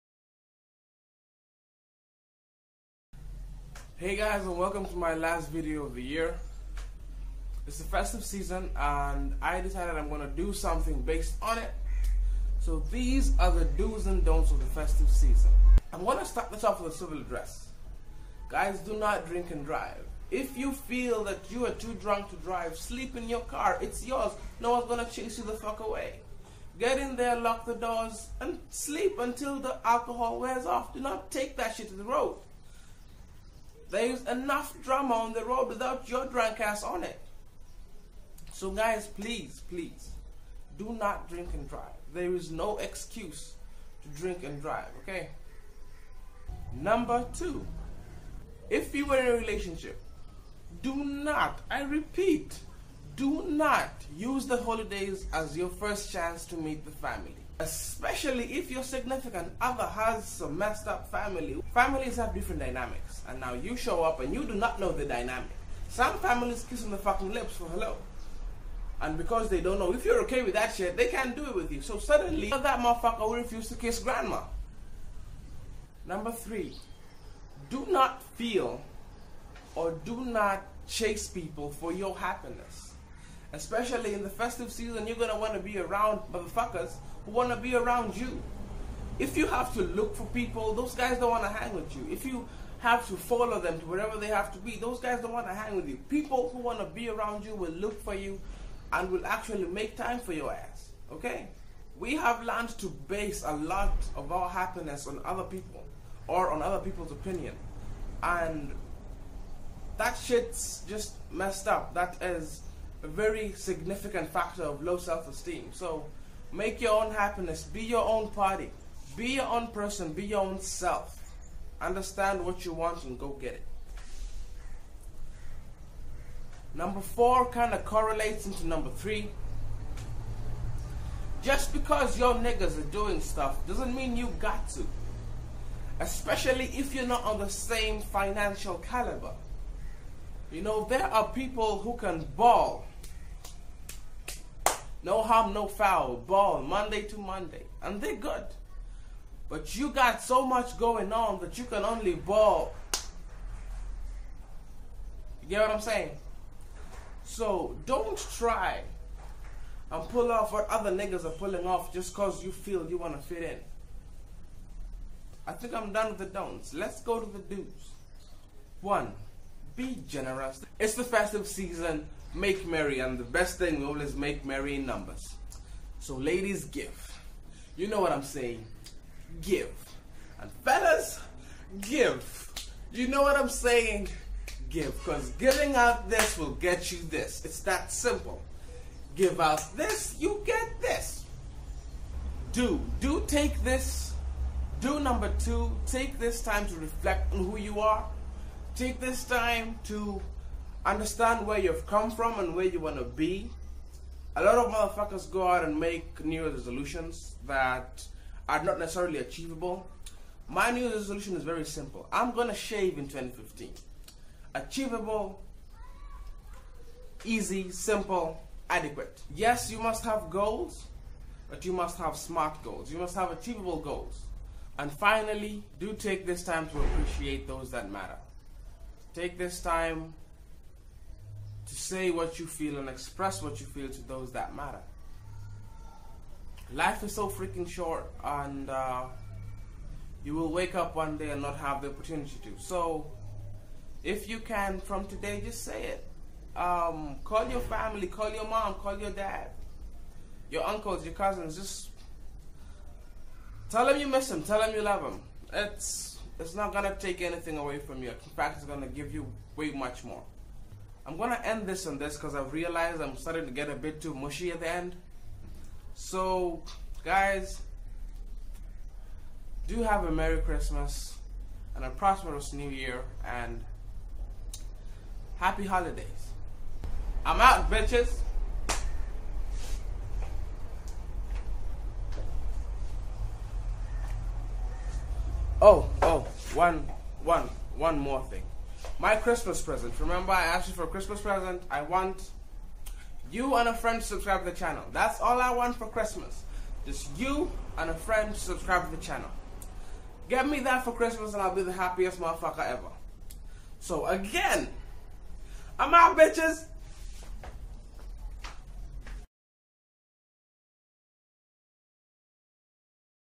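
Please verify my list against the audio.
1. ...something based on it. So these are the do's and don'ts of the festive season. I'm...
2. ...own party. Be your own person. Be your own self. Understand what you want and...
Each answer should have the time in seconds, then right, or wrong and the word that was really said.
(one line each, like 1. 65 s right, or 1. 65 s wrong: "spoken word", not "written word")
1. 10 s right
2. 118 s right.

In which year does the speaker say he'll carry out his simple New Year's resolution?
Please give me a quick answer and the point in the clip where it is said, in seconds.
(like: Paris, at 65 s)
2015, at 213 s.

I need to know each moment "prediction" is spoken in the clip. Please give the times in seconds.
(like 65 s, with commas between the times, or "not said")
not said.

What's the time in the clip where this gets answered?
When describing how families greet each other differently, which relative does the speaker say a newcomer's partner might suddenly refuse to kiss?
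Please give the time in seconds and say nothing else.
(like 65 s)
73 s.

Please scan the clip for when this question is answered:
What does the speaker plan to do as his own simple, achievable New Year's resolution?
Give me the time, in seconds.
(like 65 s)
212 s.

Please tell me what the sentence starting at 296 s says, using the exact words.
Just you and a friend to subscribe to the channel.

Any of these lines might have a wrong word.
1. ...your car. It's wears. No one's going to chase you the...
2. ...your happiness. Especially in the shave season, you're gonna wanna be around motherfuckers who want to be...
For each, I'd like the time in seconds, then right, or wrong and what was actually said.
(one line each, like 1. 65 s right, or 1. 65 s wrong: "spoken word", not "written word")
1. 23 s wrong: "yours", not "wears"
2. 81 s wrong: "festive", not "shave".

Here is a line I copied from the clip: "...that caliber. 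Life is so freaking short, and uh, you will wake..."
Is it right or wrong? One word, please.
wrong.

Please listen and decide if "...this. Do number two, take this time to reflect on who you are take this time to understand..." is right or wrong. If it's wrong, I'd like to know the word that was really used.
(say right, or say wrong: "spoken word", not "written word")
right.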